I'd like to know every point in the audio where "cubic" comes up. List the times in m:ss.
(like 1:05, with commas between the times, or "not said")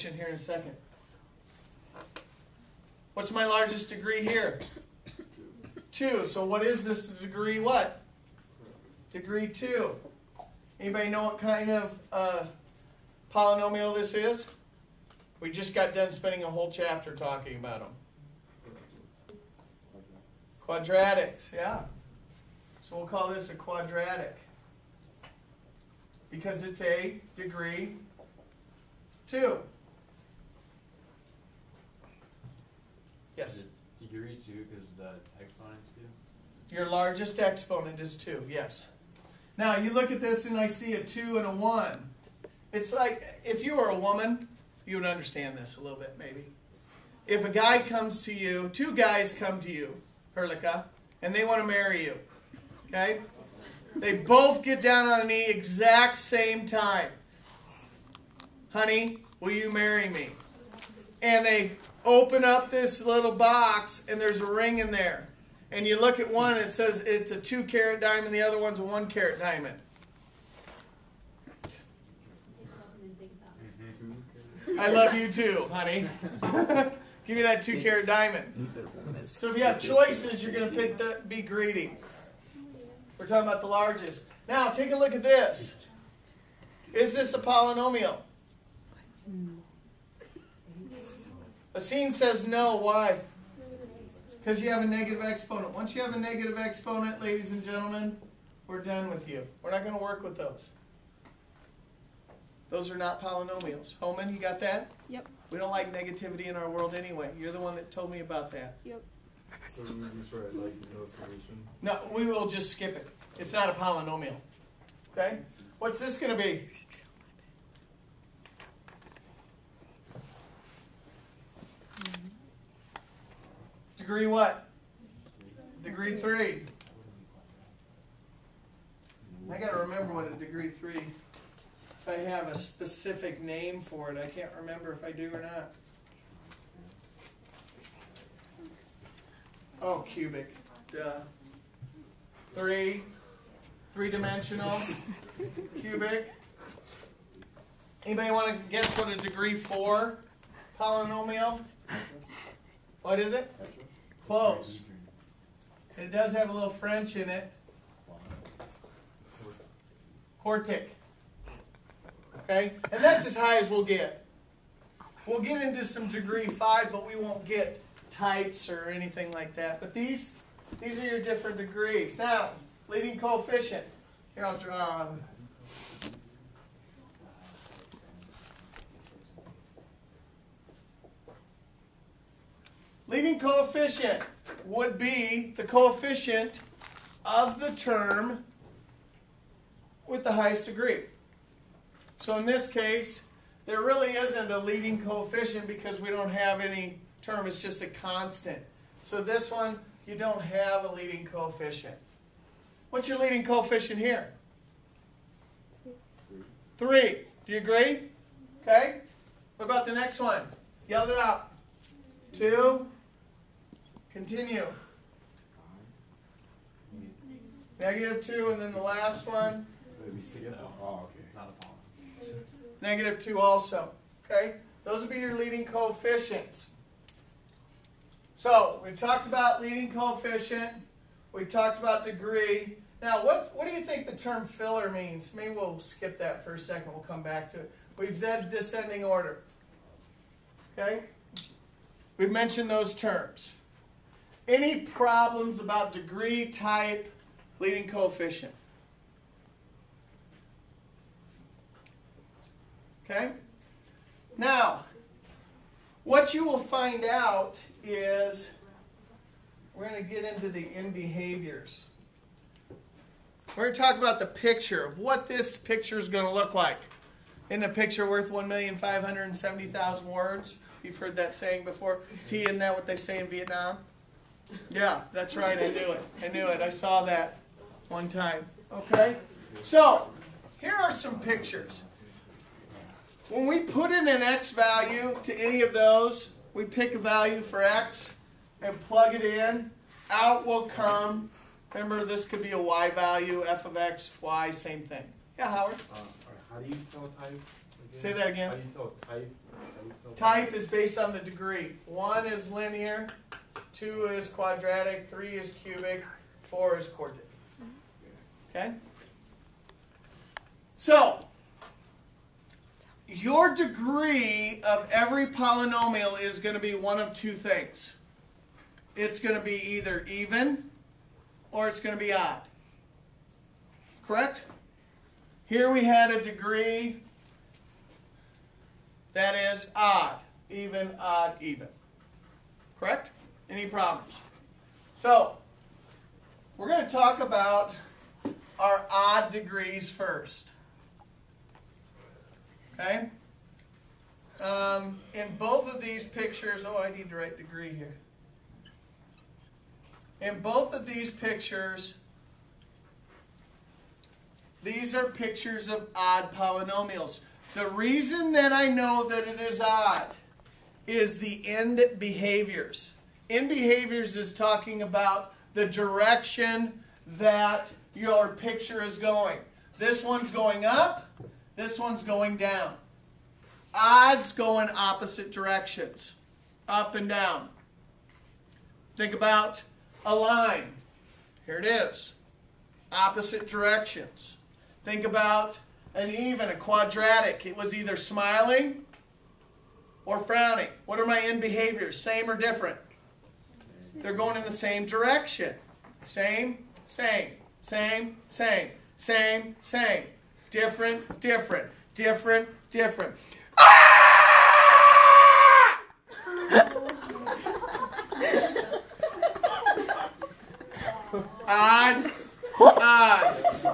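2:19, 2:25, 5:05.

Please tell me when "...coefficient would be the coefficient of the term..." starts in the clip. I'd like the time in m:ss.
3:03.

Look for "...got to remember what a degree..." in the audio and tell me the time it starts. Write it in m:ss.
2:09.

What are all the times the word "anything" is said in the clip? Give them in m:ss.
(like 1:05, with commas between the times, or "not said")
2:48.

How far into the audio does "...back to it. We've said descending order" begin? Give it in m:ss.
3:57.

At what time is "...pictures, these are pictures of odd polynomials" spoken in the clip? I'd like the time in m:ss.
5:51.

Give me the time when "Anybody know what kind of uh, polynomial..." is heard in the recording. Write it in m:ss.
0:10.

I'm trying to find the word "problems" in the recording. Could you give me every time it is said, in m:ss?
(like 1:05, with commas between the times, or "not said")
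4:04, 5:33.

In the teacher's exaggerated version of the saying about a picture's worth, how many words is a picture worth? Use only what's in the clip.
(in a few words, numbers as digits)
1,570,000.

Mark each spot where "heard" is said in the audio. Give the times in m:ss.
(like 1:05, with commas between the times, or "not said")
4:30.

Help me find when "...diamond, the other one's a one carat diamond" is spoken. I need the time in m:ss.
1:07.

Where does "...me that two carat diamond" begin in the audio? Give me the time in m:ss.
1:17.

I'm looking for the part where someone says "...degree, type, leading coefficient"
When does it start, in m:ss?
4:05.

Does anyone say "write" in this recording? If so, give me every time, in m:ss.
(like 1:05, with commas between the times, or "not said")
1:50, 5:47.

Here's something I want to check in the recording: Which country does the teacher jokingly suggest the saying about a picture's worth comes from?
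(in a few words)
Vietnam.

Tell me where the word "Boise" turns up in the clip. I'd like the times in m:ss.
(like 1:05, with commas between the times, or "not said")
not said.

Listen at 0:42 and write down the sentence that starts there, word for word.
It's like, if you were a woman, you would understand this a little bit, maybe.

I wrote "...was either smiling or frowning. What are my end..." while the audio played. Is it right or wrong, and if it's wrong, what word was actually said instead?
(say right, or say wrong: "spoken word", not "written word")
right.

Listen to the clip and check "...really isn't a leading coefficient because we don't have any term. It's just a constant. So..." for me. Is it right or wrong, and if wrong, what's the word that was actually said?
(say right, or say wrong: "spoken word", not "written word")
right.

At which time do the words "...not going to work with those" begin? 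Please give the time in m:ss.
1:39.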